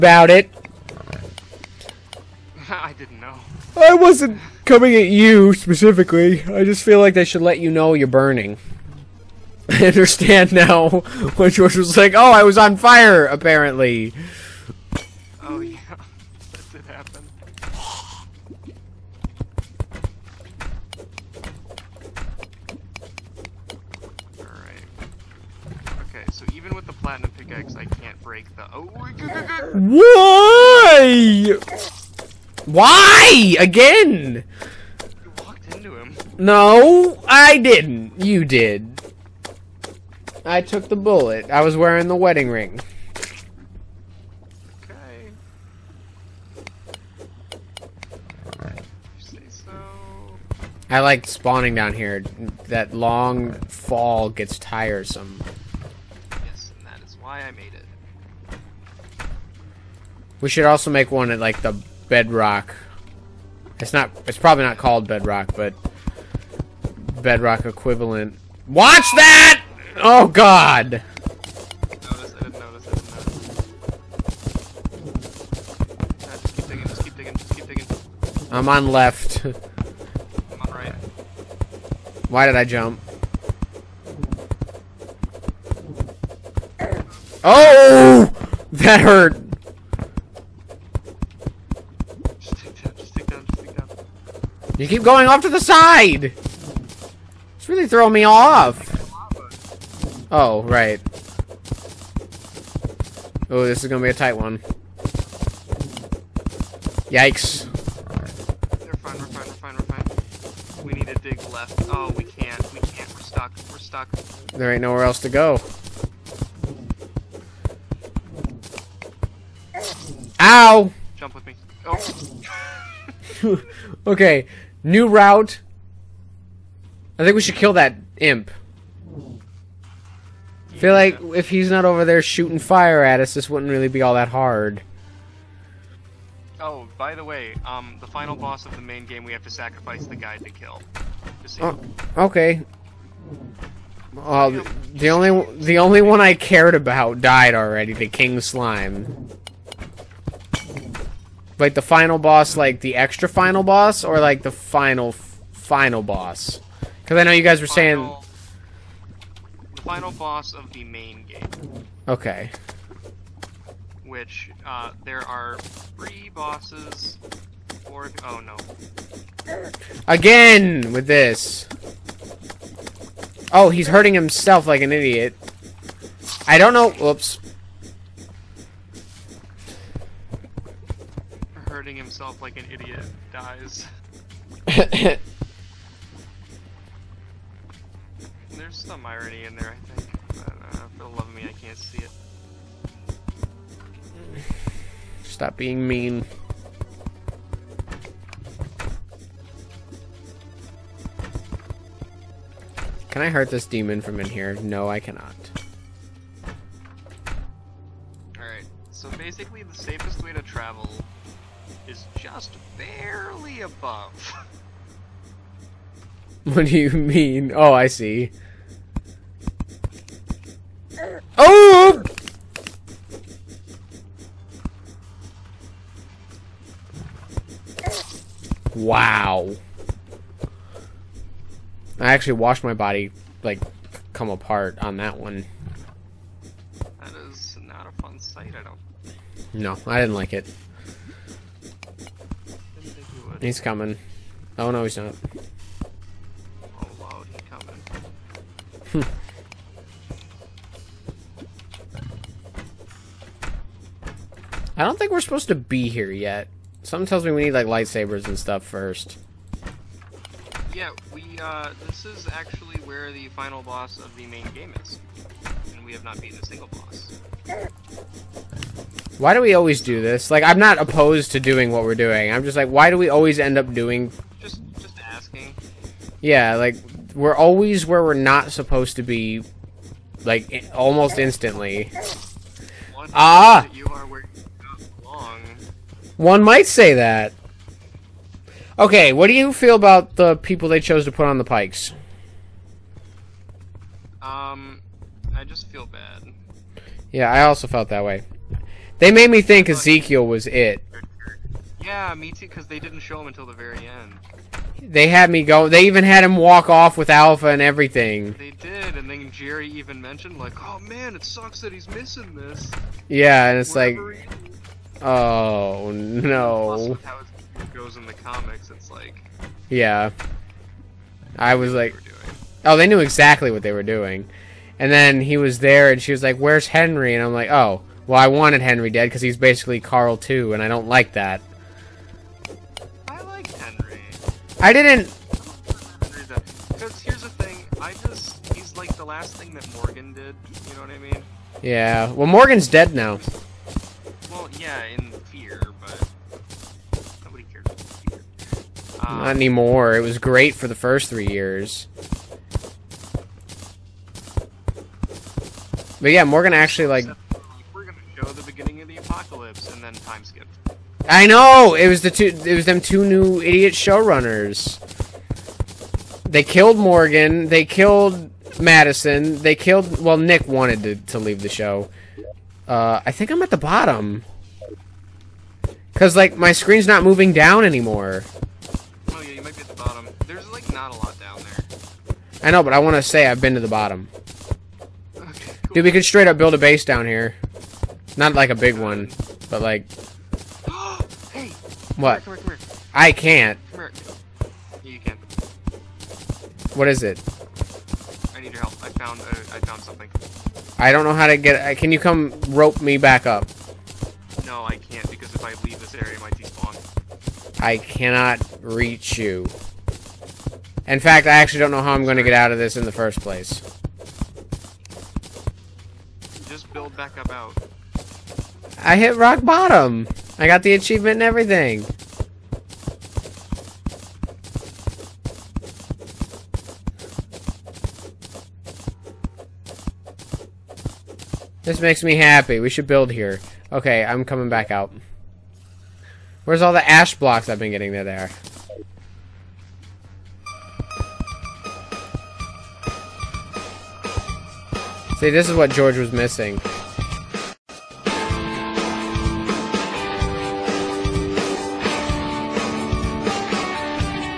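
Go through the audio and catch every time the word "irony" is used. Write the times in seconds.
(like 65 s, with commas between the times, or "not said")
189 s.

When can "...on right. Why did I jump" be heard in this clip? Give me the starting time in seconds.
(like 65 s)
80 s.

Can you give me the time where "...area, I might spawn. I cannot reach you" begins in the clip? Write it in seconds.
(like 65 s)
405 s.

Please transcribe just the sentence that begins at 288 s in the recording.
Okay, what do you feel about the people they chose to put on the pikes?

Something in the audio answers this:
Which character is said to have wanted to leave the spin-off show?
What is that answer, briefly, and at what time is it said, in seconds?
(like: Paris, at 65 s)
Nick, at 370 s.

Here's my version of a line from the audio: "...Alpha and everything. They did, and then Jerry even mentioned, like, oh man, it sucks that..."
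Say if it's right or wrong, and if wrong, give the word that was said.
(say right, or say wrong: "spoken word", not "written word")
right.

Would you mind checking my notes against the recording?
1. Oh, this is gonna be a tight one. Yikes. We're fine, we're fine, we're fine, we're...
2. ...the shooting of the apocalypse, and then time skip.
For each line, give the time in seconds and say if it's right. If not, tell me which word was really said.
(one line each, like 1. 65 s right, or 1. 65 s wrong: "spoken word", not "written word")
1. 103 s right
2. 358 s wrong: "beginning", not "shooting".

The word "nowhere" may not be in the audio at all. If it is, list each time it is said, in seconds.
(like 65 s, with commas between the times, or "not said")
114 s.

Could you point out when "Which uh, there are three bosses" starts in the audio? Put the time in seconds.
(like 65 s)
164 s.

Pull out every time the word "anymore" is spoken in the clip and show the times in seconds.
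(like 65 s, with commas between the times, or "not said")
349 s, 377 s.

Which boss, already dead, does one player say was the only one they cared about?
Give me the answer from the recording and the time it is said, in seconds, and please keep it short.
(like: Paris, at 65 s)
The King Slime, at 147 s.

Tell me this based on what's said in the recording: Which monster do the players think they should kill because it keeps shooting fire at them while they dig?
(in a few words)
imp.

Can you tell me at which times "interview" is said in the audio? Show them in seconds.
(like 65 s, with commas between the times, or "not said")
not said.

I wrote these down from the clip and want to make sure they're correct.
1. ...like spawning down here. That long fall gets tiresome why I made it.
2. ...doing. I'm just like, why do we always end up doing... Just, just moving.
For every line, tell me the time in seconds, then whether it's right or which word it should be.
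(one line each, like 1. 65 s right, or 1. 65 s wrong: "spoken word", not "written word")
1. 51 s right
2. 271 s wrong: "asking", not "moving".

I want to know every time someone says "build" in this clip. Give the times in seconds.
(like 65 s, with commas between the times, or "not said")
386 s, 416 s, 432 s.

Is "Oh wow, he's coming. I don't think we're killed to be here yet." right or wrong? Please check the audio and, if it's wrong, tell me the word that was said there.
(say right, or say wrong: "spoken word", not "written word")
wrong: "supposed", not "killed".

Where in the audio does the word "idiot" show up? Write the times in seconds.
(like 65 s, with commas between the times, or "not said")
174 s, 182 s, 363 s.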